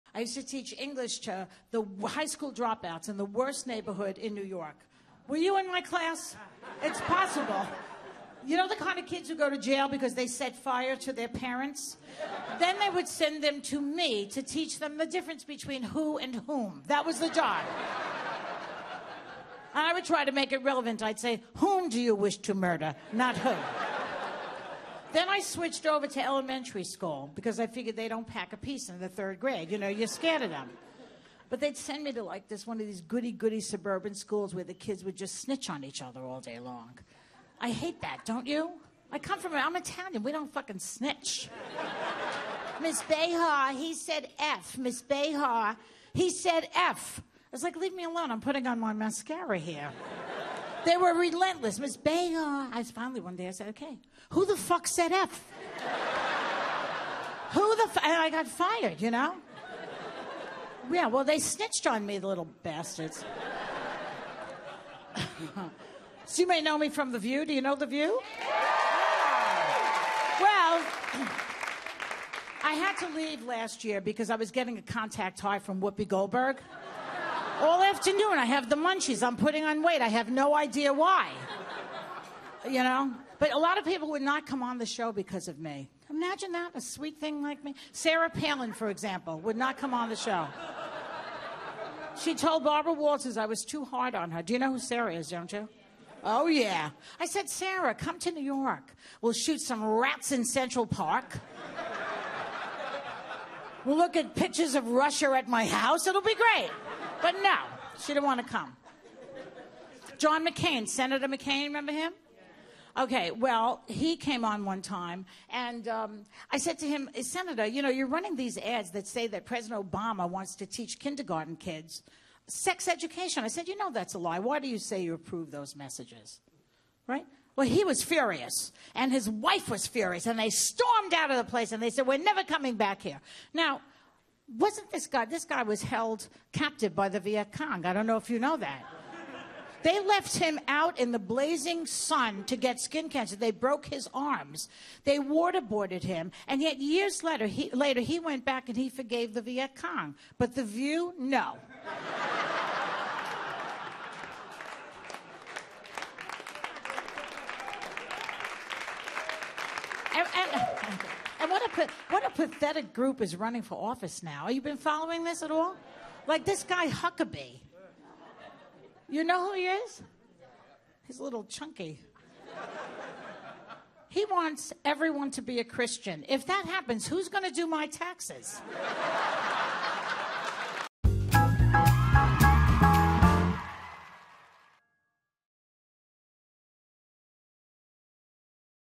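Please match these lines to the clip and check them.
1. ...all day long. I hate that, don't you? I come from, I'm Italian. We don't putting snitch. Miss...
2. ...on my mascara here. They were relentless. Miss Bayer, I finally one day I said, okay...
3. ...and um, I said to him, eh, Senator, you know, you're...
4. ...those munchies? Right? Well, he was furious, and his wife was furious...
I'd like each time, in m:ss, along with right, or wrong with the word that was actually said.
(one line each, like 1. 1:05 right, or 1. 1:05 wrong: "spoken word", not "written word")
1. 0:36 wrong: "fucking", not "putting"
2. 0:48 right
3. 1:55 right
4. 2:05 wrong: "messages", not "munchies".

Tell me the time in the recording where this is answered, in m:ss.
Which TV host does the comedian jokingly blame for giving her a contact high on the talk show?
1:15.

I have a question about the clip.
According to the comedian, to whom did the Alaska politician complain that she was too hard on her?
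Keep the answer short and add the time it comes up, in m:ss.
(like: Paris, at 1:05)
Barbara Walters, at 1:32.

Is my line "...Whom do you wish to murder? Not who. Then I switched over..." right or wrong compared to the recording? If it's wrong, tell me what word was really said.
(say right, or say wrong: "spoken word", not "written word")
right.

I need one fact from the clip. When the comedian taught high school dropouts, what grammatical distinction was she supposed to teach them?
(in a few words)
who and whom.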